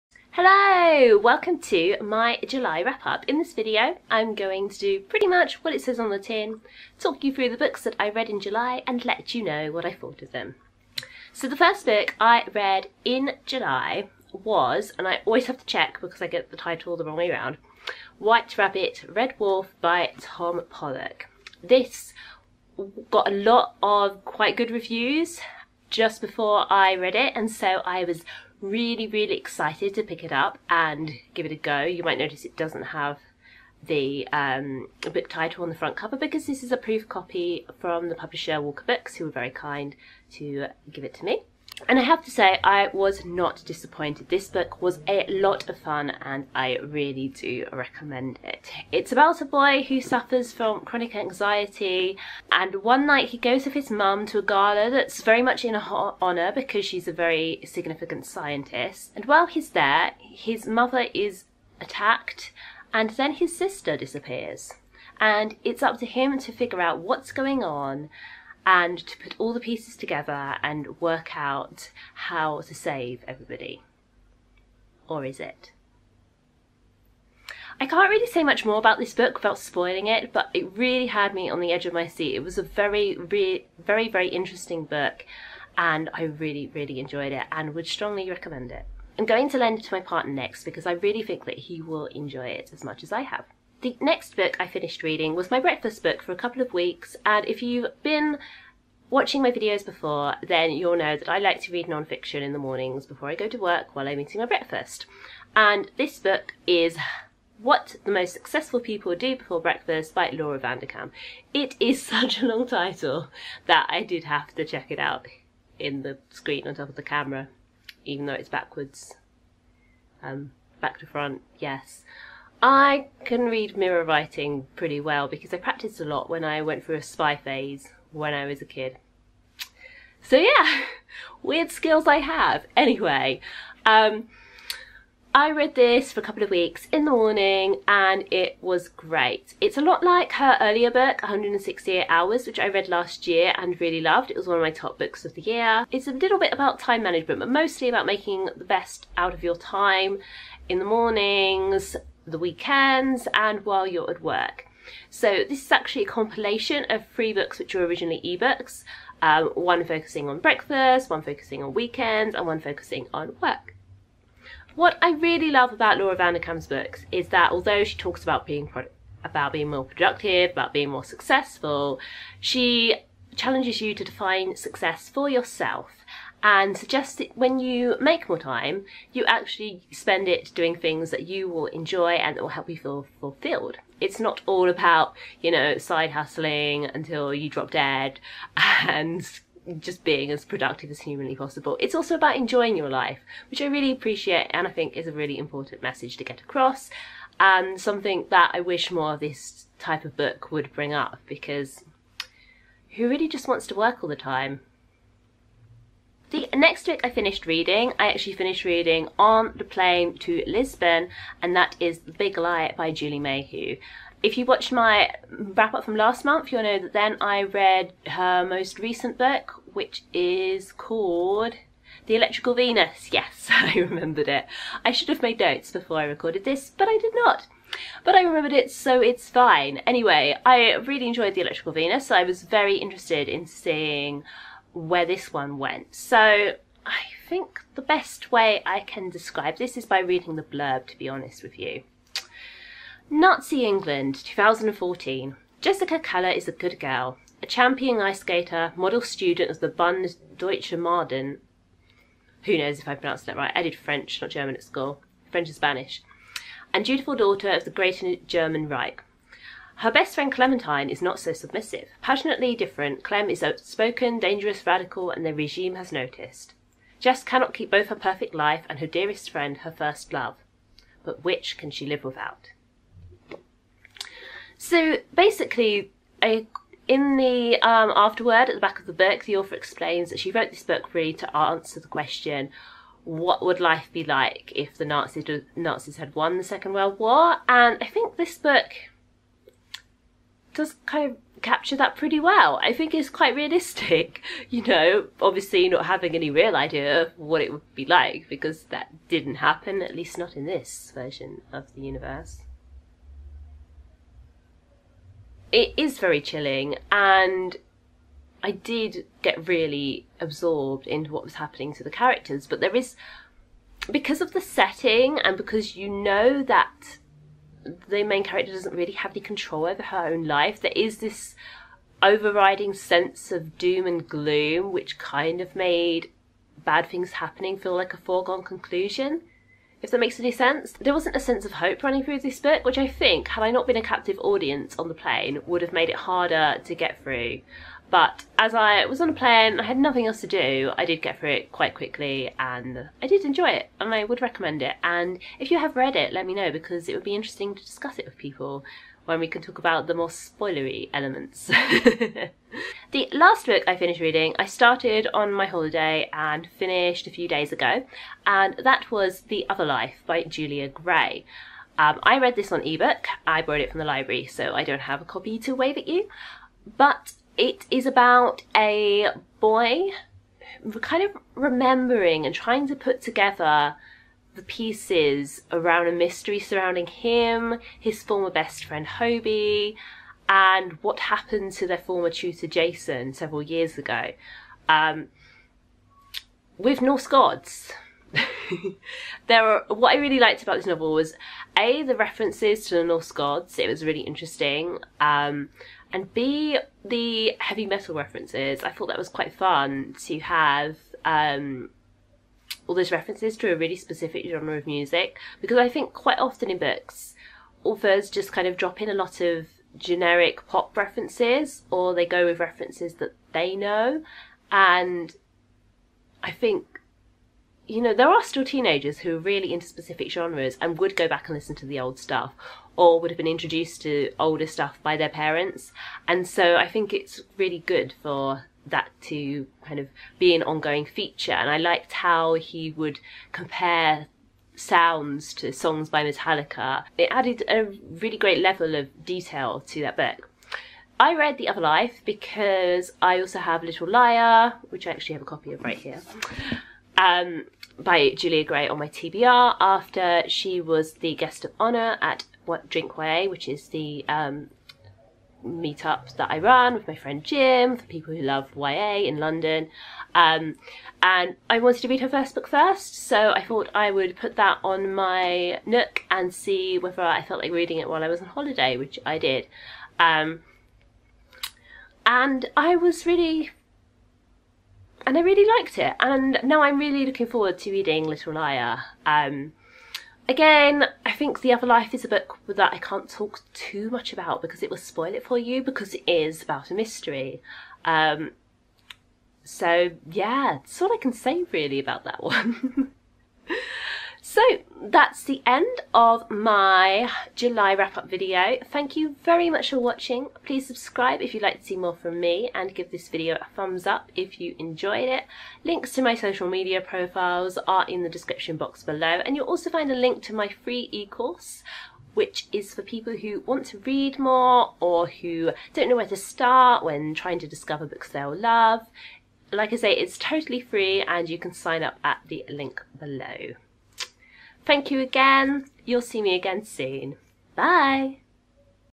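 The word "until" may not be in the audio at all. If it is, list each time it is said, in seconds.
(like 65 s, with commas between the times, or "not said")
186 s.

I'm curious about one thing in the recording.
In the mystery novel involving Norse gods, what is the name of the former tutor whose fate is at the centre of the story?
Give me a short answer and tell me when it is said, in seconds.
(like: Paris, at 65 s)
Jason, at 382 s.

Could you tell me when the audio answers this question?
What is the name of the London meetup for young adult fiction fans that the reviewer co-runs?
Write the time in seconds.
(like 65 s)
452 s.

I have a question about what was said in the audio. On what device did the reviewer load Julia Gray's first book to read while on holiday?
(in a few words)
Nook.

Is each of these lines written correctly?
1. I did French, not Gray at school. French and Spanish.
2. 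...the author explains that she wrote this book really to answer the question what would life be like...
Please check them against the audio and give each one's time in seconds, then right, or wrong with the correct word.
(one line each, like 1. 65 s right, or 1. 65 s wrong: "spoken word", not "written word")
1. 253 s wrong: "German", not "Gray"
2. 279 s right.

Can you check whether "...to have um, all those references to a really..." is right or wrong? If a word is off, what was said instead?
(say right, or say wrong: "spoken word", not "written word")
right.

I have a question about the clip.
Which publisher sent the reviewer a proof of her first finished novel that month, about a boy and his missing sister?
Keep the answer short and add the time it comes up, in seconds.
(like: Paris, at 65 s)
Walker Books, at 38 s.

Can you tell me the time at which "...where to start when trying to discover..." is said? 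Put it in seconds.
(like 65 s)
515 s.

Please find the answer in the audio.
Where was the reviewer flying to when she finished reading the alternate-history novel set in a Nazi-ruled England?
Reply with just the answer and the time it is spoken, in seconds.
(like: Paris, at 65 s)
Lisbon, at 210 s.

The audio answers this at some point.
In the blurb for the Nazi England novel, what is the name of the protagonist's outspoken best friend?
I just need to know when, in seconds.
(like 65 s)
260 s.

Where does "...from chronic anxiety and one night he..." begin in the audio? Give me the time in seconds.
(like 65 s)
50 s.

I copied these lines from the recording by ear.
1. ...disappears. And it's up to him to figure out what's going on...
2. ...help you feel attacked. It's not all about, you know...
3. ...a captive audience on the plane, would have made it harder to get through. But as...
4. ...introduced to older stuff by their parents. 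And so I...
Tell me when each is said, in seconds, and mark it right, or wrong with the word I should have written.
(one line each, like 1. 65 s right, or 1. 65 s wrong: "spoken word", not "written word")
1. 63 s right
2. 182 s wrong: "fulfilled", not "attacked"
3. 333 s right
4. 423 s right.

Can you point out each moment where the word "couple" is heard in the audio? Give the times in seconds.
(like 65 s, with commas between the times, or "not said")
96 s, 136 s.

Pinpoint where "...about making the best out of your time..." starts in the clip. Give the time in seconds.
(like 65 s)
147 s.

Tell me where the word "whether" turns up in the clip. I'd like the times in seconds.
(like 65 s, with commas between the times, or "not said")
466 s.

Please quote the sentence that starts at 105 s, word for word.
And this book is What the Most Successful People Do Before Breakfast by Laura Vanderkam.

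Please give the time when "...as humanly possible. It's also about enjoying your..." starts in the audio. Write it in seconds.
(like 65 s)
190 s.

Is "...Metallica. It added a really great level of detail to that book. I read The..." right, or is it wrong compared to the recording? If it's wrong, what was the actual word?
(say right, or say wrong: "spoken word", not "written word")
right.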